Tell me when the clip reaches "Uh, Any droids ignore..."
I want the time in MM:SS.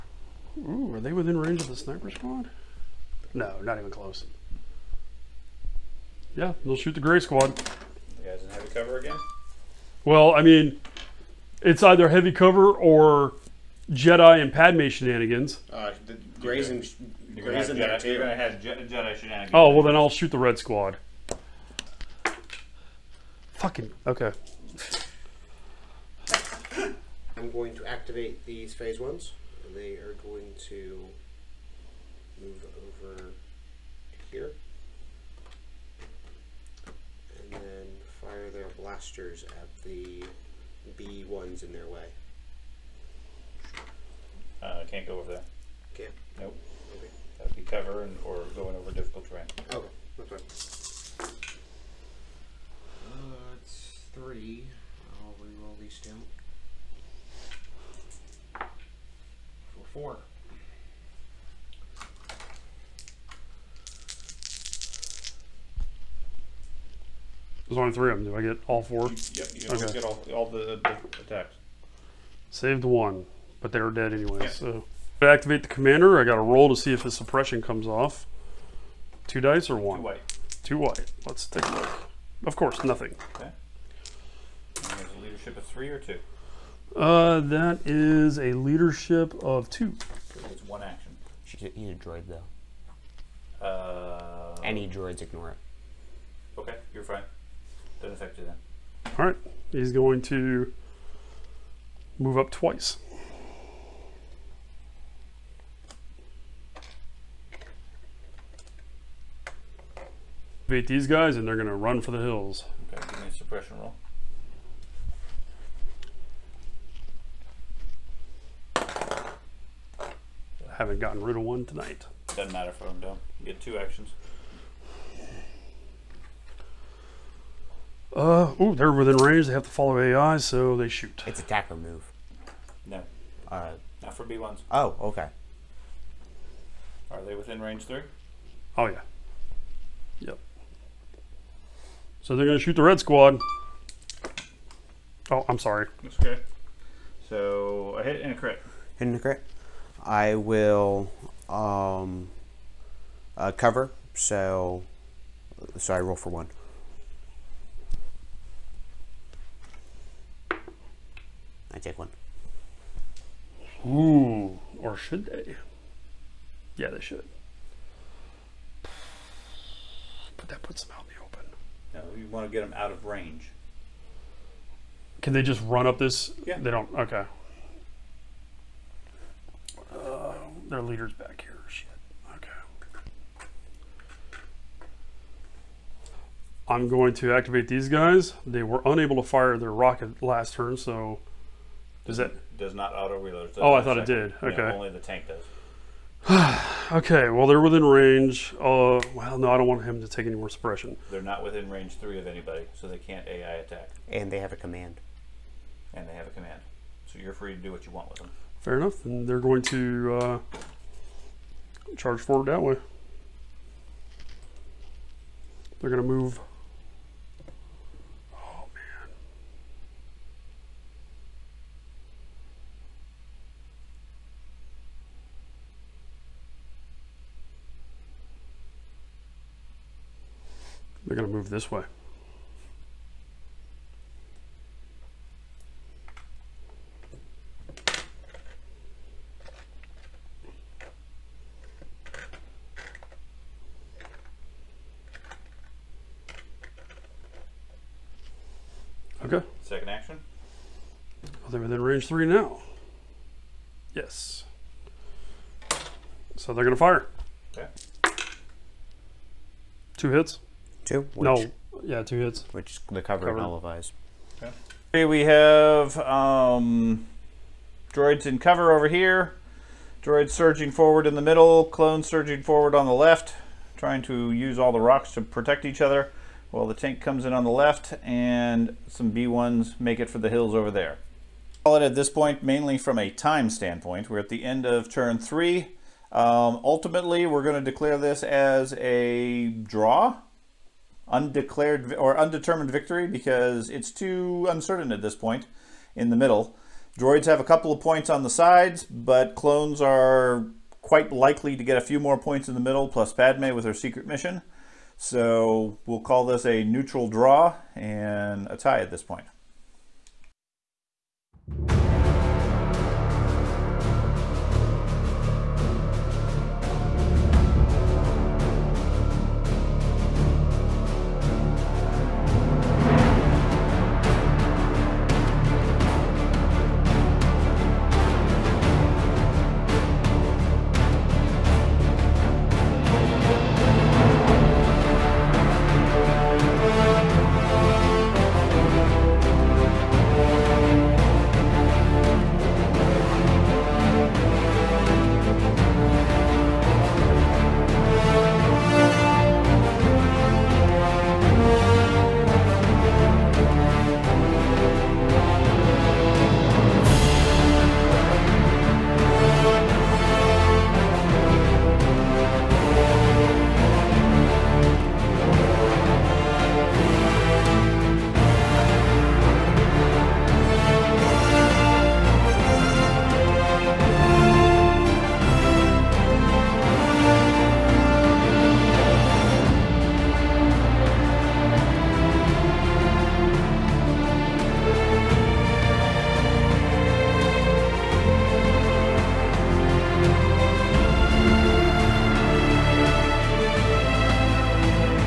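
01:33.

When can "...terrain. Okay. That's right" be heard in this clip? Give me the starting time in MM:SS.
00:49.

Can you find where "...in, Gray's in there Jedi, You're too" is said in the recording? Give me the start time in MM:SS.
00:16.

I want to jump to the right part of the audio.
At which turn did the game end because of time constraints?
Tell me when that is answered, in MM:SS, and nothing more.
04:44.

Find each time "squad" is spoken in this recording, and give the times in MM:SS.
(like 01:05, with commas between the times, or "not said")
00:02, 00:07, 00:20, 02:22.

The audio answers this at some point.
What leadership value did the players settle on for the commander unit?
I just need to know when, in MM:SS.
01:28.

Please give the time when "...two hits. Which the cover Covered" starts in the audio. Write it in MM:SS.
04:22.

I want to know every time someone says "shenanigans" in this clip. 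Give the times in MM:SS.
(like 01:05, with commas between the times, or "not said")
00:14, 00:19.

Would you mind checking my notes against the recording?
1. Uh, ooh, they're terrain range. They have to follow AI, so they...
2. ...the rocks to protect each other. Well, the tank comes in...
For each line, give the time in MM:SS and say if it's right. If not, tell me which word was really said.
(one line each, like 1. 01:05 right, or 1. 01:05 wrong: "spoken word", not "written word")
1. 02:08 wrong: "within", not "terrain"
2. 04:34 right.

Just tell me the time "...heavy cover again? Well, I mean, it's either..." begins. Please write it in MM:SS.
00:08.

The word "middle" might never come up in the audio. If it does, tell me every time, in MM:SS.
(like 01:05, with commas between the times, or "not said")
04:31, 04:56, 05:02.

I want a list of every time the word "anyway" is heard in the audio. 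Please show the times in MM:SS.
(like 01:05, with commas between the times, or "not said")
01:14.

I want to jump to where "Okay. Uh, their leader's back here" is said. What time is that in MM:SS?
02:56.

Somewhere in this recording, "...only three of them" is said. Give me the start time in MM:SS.
01:07.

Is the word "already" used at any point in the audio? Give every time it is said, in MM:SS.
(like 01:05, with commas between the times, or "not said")
not said.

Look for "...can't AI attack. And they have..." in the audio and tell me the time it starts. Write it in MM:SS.
03:22.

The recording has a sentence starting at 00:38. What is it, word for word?
pastures at the B ones in their way.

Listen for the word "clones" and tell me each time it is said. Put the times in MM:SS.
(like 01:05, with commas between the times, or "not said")
04:31, 04:59.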